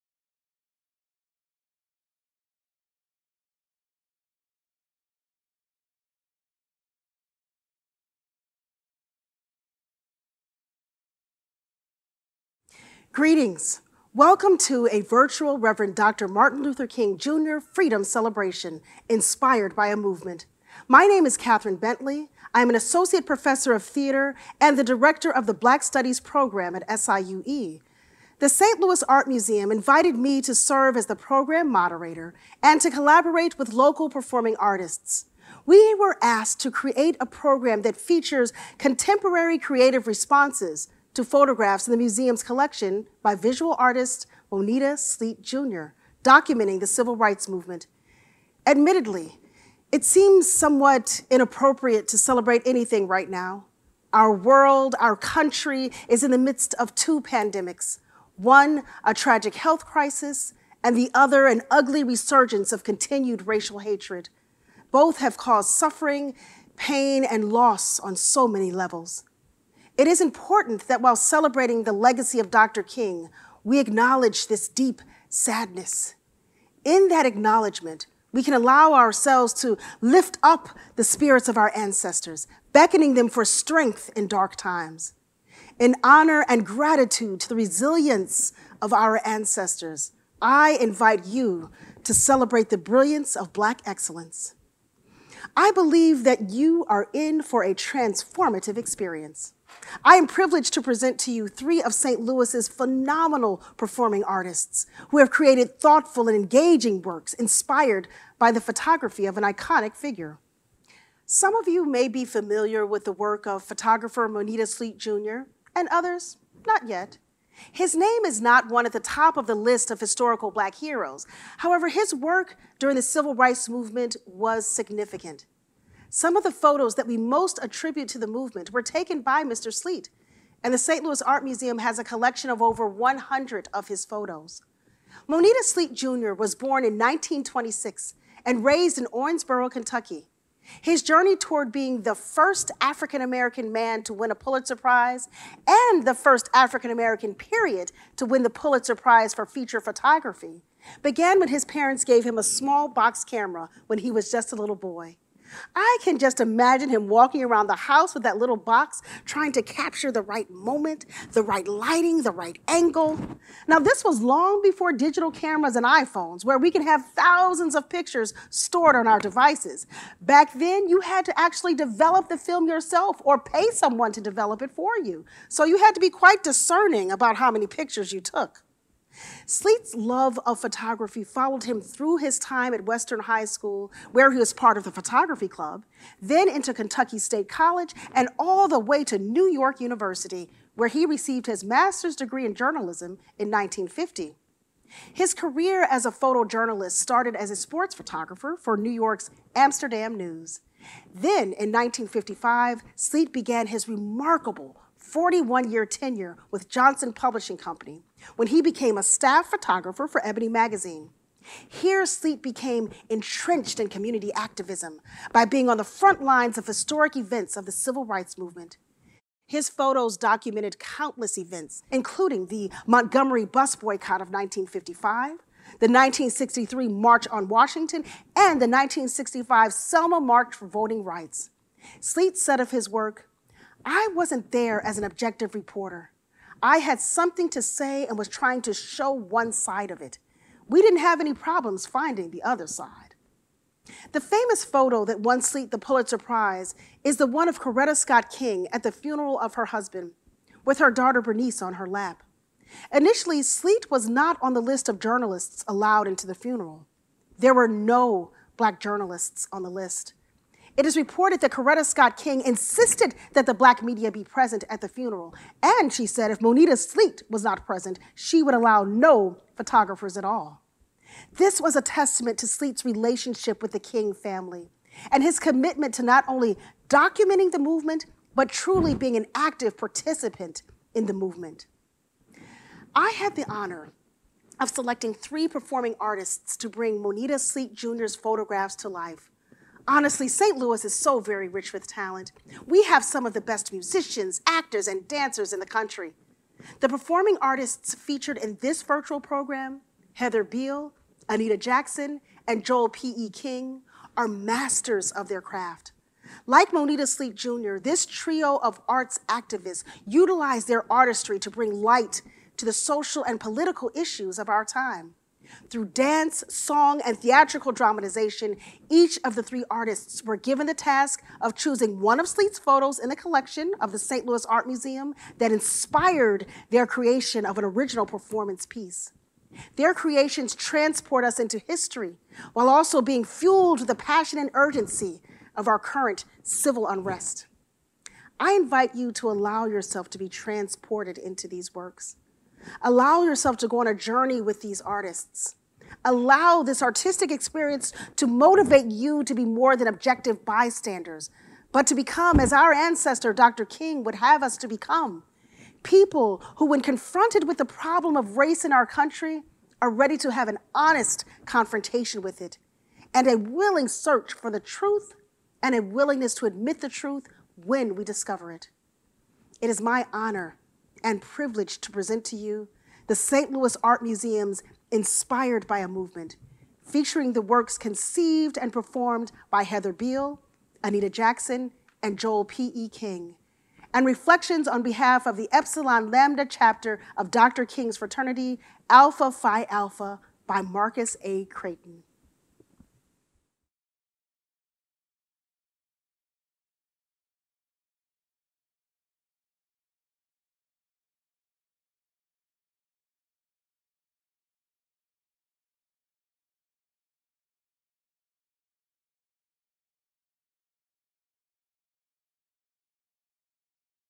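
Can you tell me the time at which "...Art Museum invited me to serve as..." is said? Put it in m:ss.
0:29.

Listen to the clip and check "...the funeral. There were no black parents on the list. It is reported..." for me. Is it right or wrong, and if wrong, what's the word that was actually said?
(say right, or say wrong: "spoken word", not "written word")
wrong: "journalists", not "parents".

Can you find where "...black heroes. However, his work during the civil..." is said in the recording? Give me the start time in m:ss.
2:00.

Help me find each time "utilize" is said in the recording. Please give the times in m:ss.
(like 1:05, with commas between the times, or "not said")
5:10.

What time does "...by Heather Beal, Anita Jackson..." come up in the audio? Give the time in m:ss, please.
6:19.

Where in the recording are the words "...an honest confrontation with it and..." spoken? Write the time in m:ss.
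6:00.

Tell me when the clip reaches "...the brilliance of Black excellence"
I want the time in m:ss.
1:32.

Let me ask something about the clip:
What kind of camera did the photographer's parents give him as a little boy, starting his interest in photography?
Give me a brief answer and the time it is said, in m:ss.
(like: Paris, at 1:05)
a small box camera, at 2:32.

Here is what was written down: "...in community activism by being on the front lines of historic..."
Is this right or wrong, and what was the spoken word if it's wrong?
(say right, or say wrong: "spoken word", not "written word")
right.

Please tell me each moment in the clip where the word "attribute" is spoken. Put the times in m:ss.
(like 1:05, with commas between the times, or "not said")
2:07.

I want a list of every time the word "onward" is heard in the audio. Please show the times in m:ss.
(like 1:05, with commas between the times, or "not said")
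not said.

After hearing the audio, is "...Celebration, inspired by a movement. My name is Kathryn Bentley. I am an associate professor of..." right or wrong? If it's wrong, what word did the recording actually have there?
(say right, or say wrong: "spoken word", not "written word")
right.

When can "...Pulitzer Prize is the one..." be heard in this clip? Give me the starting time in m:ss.
4:05.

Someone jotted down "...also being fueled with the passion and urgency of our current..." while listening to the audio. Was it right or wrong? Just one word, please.
right.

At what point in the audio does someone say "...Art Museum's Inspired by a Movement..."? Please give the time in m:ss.
6:13.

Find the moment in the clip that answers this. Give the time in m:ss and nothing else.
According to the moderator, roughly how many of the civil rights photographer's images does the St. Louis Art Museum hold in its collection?
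2:12.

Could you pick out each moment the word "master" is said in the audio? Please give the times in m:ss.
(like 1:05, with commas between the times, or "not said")
3:11, 5:04.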